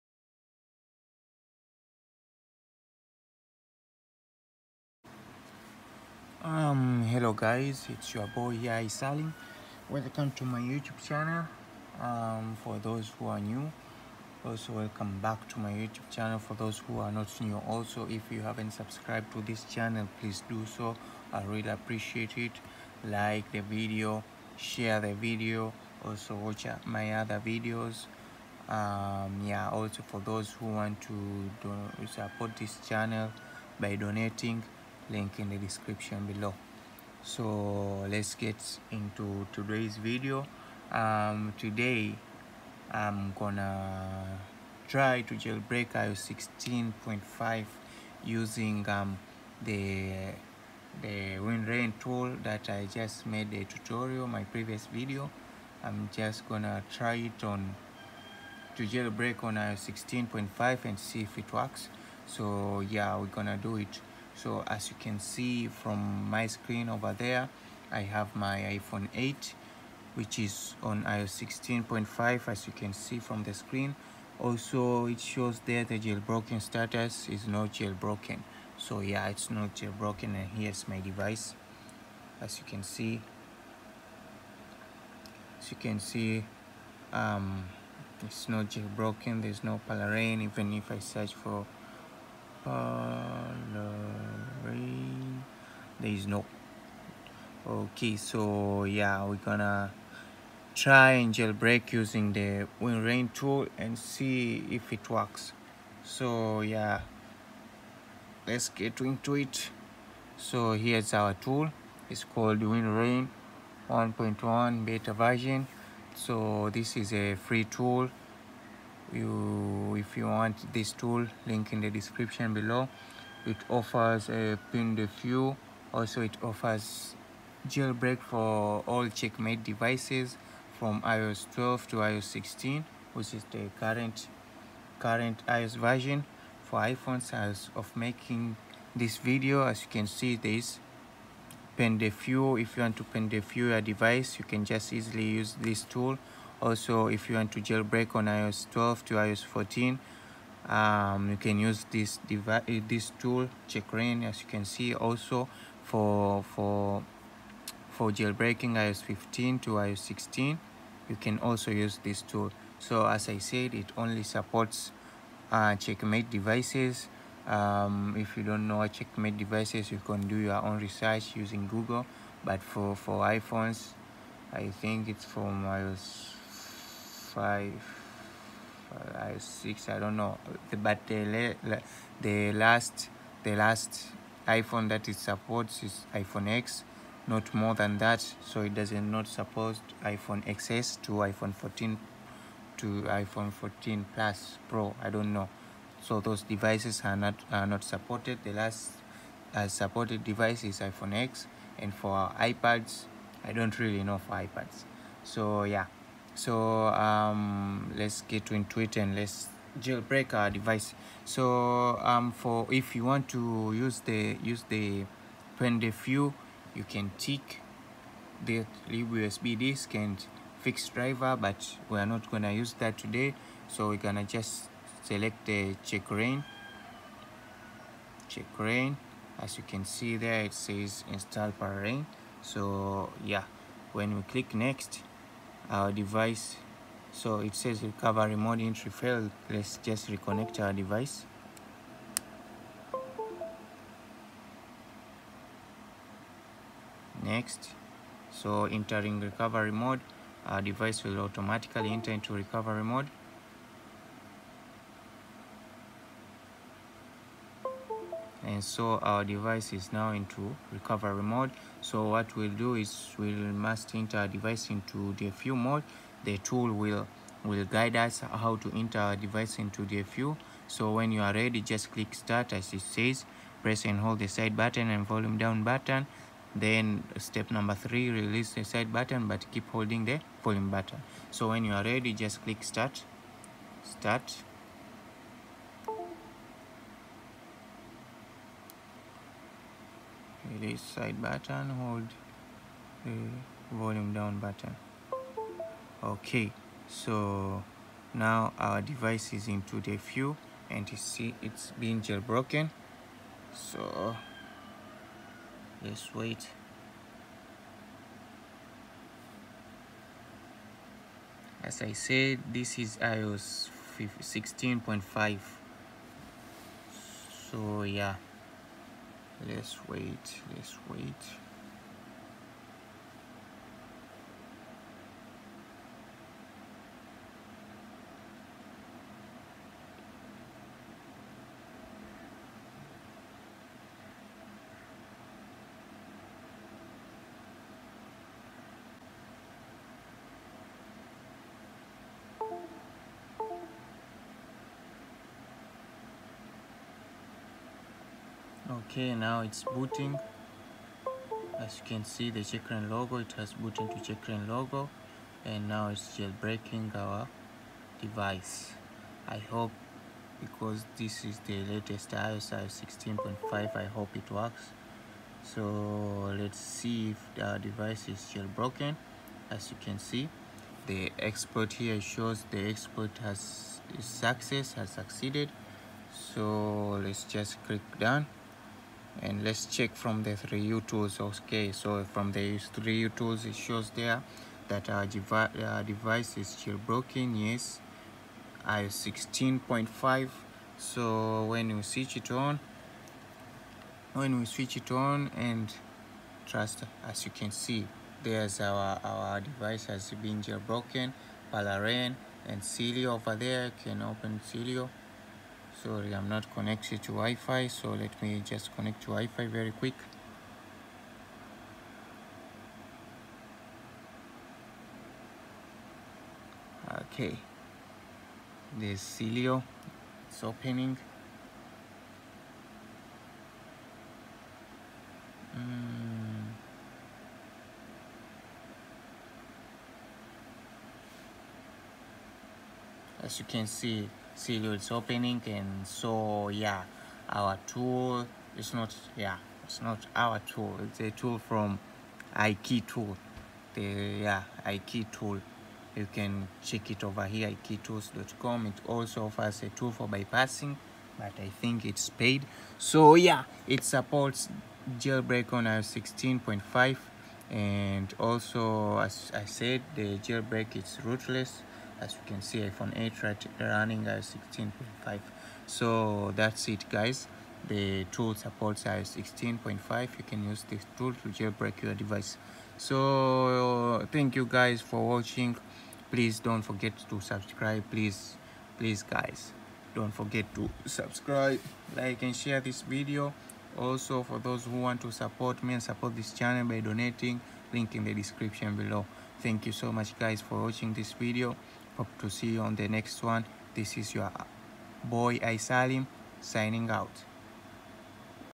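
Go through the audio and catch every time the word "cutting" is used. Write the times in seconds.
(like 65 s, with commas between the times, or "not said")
not said.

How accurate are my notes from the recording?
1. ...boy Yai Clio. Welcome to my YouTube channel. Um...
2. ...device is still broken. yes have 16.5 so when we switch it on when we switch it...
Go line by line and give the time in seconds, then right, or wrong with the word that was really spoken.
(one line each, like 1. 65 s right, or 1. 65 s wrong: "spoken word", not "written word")
1. 8 s wrong: "Salim", not "Clio"
2. 385 s right.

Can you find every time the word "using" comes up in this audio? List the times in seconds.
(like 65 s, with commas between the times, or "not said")
48 s, 101 s, 171 s.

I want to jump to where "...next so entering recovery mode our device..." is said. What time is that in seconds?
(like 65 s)
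247 s.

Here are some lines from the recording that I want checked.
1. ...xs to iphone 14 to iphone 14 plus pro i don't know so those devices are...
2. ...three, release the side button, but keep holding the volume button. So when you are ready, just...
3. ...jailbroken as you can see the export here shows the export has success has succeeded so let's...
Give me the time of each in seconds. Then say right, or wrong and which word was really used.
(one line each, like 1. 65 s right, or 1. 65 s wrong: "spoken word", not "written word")
1. 190 s right
2. 277 s right
3. 368 s right.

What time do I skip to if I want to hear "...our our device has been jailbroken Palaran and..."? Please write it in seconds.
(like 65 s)
398 s.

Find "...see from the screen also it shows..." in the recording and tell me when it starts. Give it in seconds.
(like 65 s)
72 s.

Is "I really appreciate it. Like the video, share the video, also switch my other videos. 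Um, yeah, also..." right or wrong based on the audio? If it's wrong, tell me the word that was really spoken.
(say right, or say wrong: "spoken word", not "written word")
wrong: "watch", not "switch".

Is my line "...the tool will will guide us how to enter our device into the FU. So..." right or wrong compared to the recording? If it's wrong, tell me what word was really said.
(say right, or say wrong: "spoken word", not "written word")
right.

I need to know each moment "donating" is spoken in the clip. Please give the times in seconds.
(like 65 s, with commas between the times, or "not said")
33 s, 486 s.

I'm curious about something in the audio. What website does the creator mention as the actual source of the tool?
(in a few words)
ikeytools.com.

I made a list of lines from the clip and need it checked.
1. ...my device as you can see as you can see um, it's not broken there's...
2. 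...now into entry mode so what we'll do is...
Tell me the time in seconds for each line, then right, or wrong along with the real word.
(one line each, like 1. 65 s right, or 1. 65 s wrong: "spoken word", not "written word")
1. 80 s wrong: "jailbroken", not "broken"
2. 259 s wrong: "recovery", not "entry".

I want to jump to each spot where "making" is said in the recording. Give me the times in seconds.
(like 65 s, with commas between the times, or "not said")
137 s.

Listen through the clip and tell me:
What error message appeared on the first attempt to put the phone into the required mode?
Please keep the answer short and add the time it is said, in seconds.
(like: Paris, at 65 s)
recovery mode entry failed, at 237 s.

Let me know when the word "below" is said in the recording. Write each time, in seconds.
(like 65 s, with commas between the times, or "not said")
36 s, 122 s, 488 s.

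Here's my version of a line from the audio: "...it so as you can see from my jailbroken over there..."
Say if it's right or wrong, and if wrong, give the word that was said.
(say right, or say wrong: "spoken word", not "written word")
wrong: "screen", not "jailbroken".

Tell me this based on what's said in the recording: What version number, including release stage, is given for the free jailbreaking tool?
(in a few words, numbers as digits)
1.1 beta.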